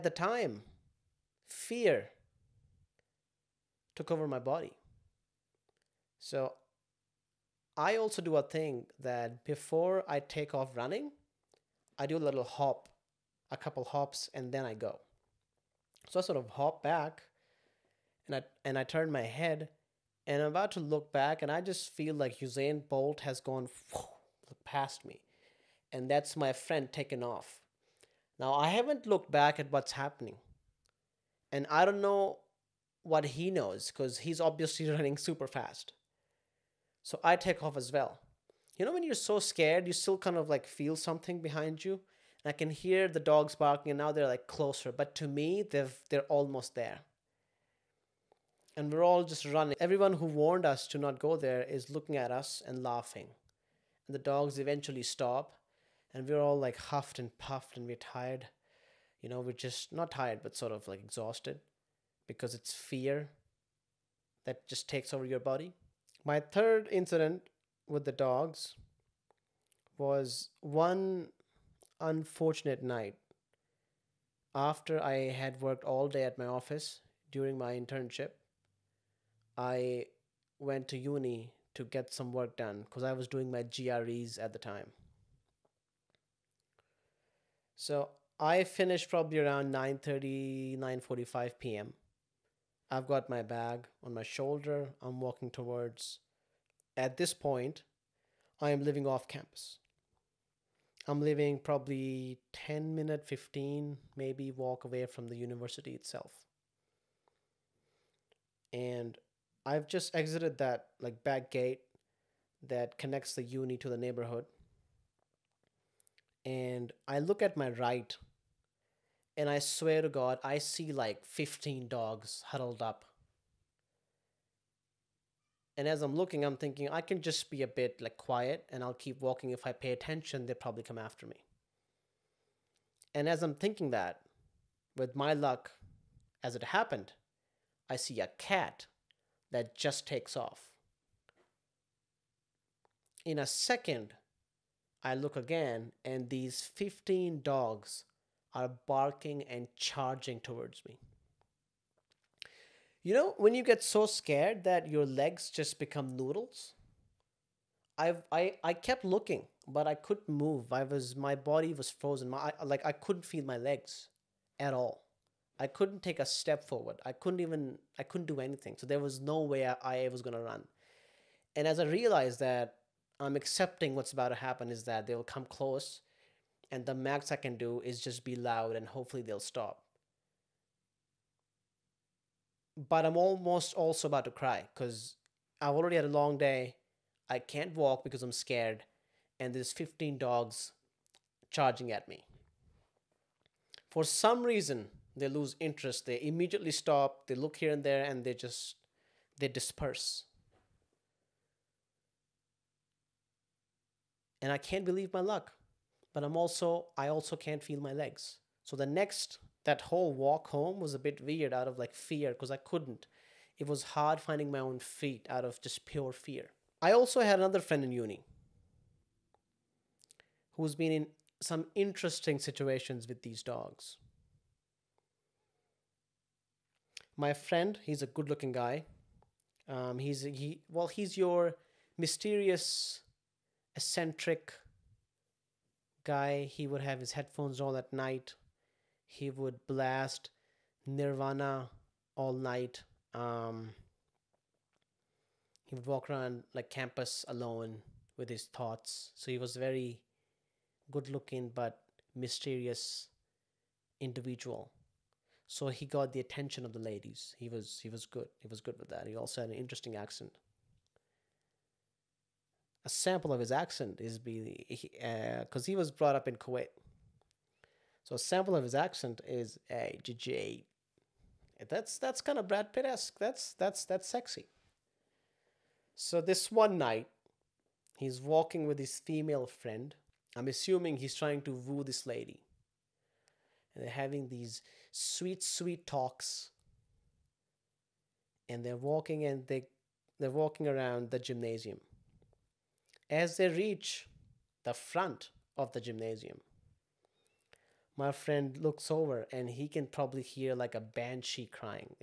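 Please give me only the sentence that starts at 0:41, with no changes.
And I can hear the dogs barking, and now they're like closer.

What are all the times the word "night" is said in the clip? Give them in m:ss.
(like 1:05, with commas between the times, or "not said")
1:12, 3:57, 4:02, 4:36.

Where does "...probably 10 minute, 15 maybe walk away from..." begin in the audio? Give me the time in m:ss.
1:41.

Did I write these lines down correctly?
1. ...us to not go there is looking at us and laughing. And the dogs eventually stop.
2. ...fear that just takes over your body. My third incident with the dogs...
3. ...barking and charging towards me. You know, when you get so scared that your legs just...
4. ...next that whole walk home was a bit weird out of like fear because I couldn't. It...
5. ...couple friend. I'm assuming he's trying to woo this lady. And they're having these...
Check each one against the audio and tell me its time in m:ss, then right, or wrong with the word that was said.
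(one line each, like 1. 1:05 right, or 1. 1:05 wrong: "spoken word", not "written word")
1. 0:50 right
2. 1:02 right
3. 2:28 right
4. 3:28 right
5. 4:38 wrong: "female", not "couple".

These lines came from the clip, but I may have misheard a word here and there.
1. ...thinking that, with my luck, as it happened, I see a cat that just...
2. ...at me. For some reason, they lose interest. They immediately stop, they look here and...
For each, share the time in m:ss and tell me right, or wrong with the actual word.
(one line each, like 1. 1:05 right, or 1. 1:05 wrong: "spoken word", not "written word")
1. 2:13 right
2. 3:11 right.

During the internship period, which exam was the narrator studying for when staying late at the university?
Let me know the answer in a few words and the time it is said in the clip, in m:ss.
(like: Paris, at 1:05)
GREs, at 1:23.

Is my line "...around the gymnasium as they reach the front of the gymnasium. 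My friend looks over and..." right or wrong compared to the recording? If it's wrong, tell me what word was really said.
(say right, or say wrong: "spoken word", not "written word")
right.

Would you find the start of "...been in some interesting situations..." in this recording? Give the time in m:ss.
3:40.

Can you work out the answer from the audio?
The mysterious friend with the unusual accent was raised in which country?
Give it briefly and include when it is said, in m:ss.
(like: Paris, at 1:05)
Kuwait, at 4:26.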